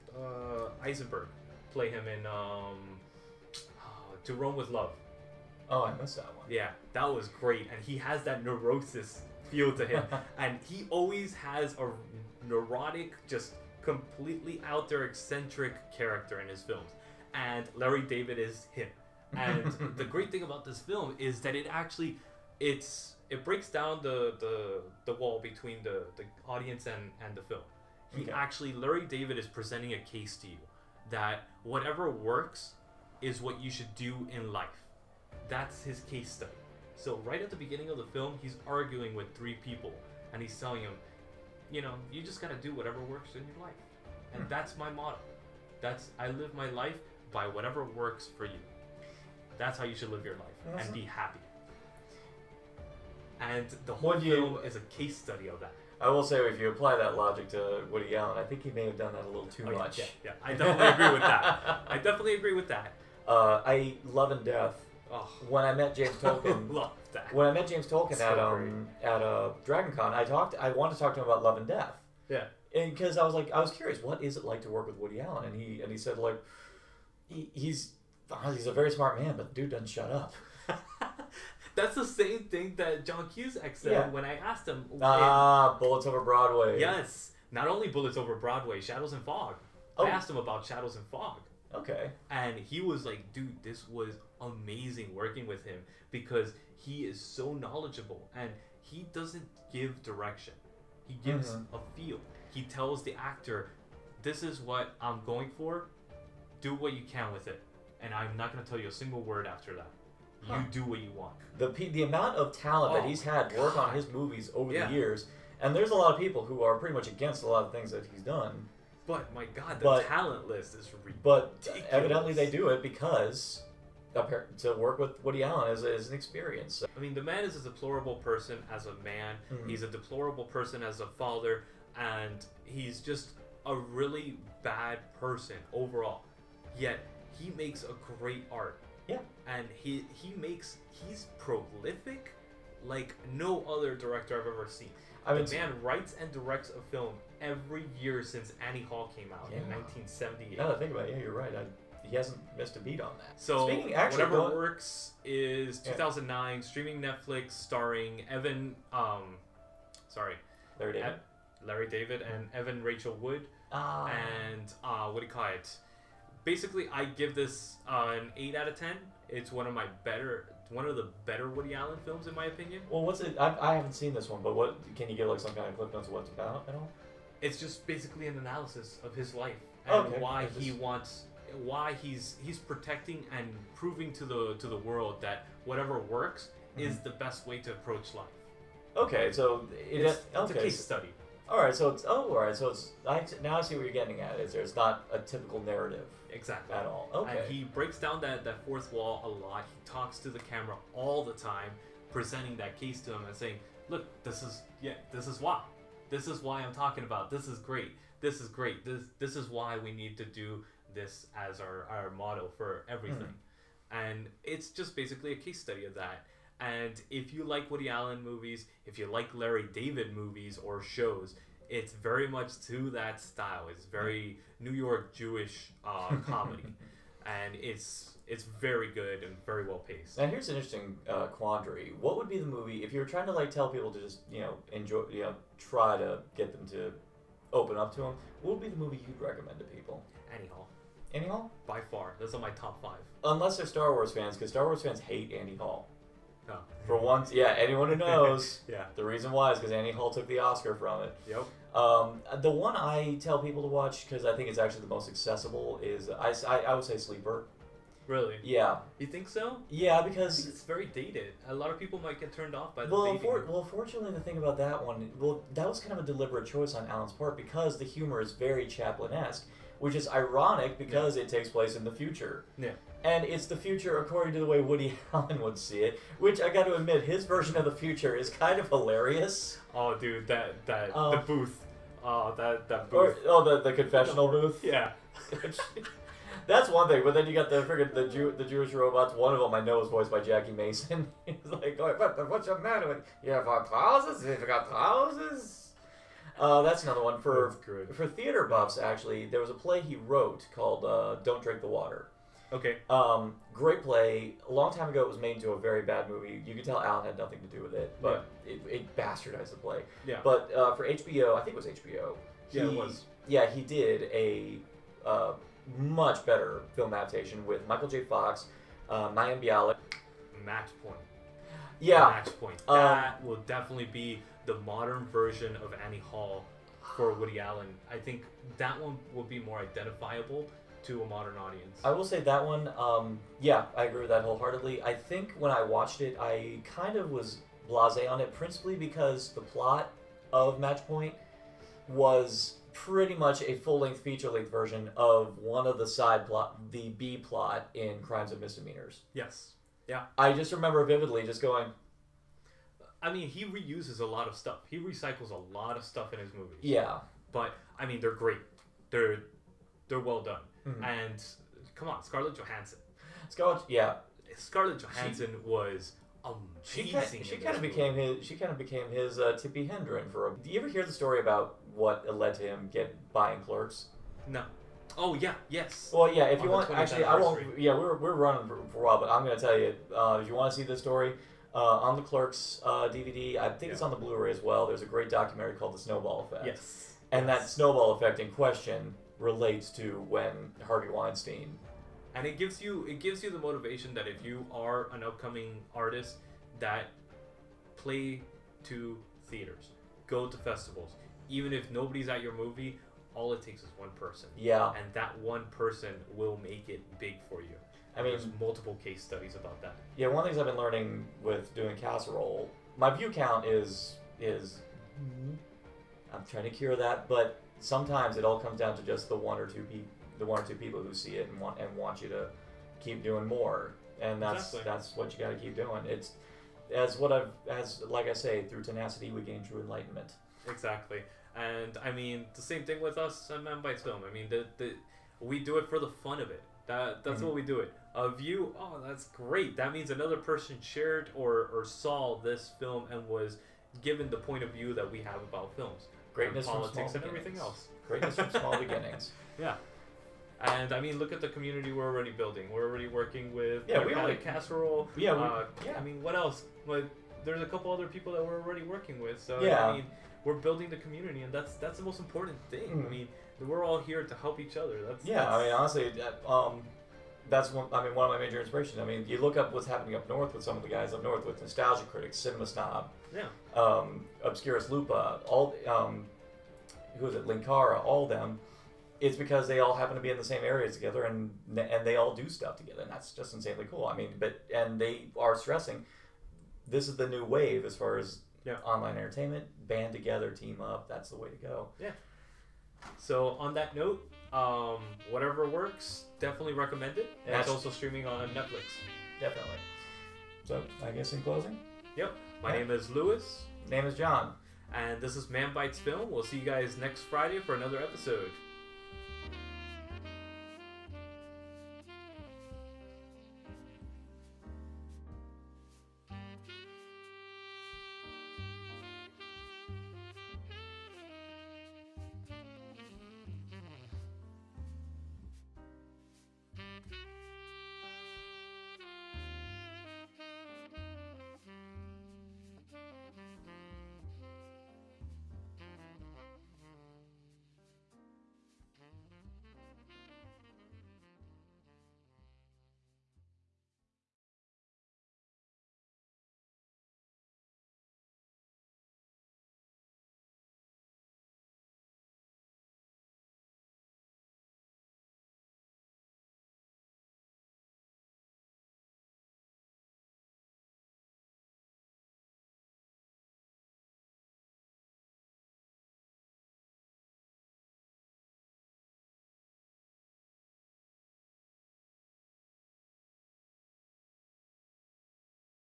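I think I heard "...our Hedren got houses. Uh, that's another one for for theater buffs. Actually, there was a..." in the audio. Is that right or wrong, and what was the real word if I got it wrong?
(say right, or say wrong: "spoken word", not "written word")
wrong: "You", not "Hedren".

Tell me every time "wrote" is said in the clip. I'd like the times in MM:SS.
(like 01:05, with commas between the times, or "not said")
04:59.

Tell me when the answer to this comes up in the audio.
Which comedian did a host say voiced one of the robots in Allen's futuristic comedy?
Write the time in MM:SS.
04:50.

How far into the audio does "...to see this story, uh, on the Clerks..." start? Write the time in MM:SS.
06:20.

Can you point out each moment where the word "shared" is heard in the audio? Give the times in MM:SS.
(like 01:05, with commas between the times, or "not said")
07:20.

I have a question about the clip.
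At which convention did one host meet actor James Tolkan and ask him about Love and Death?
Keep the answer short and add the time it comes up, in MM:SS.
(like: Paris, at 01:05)
DragonCon, at 01:09.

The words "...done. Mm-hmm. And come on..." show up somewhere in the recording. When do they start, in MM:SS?
06:00.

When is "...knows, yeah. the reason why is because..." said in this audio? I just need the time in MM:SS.
04:07.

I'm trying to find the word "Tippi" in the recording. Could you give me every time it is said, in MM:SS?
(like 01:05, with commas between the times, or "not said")
06:09.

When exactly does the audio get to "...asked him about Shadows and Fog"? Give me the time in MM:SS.
01:30.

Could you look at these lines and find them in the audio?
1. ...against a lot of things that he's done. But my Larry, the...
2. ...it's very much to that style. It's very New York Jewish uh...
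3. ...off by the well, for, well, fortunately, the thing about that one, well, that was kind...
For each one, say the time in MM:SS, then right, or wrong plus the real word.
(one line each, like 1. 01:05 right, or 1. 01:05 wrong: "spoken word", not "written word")
1. 01:57 wrong: "God", not "Larry"
2. 03:41 right
3. 04:22 right.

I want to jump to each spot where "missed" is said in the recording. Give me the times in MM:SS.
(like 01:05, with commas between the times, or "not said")
00:06, 02:32.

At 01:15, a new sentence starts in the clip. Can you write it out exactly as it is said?
And he and he said like, he, he's ah, he's a very smart man, but the dude doesn't shut up.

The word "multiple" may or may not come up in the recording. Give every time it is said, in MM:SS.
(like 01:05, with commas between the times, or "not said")
06:48.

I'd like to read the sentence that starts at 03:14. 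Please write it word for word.
Is there's not a typical narrative exactly at all?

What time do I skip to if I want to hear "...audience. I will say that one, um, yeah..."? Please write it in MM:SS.
05:31.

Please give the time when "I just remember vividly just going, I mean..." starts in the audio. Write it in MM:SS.
05:50.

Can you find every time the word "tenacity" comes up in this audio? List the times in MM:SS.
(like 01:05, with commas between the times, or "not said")
07:08.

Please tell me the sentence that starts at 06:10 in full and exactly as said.
Do you ever hear the story about what led to him get buying Clerks?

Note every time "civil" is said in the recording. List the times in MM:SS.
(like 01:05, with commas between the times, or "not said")
not said.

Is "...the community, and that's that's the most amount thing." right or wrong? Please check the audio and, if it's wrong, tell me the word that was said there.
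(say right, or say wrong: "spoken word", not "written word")
wrong: "important", not "amount".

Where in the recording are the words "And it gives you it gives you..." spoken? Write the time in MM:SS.
06:32.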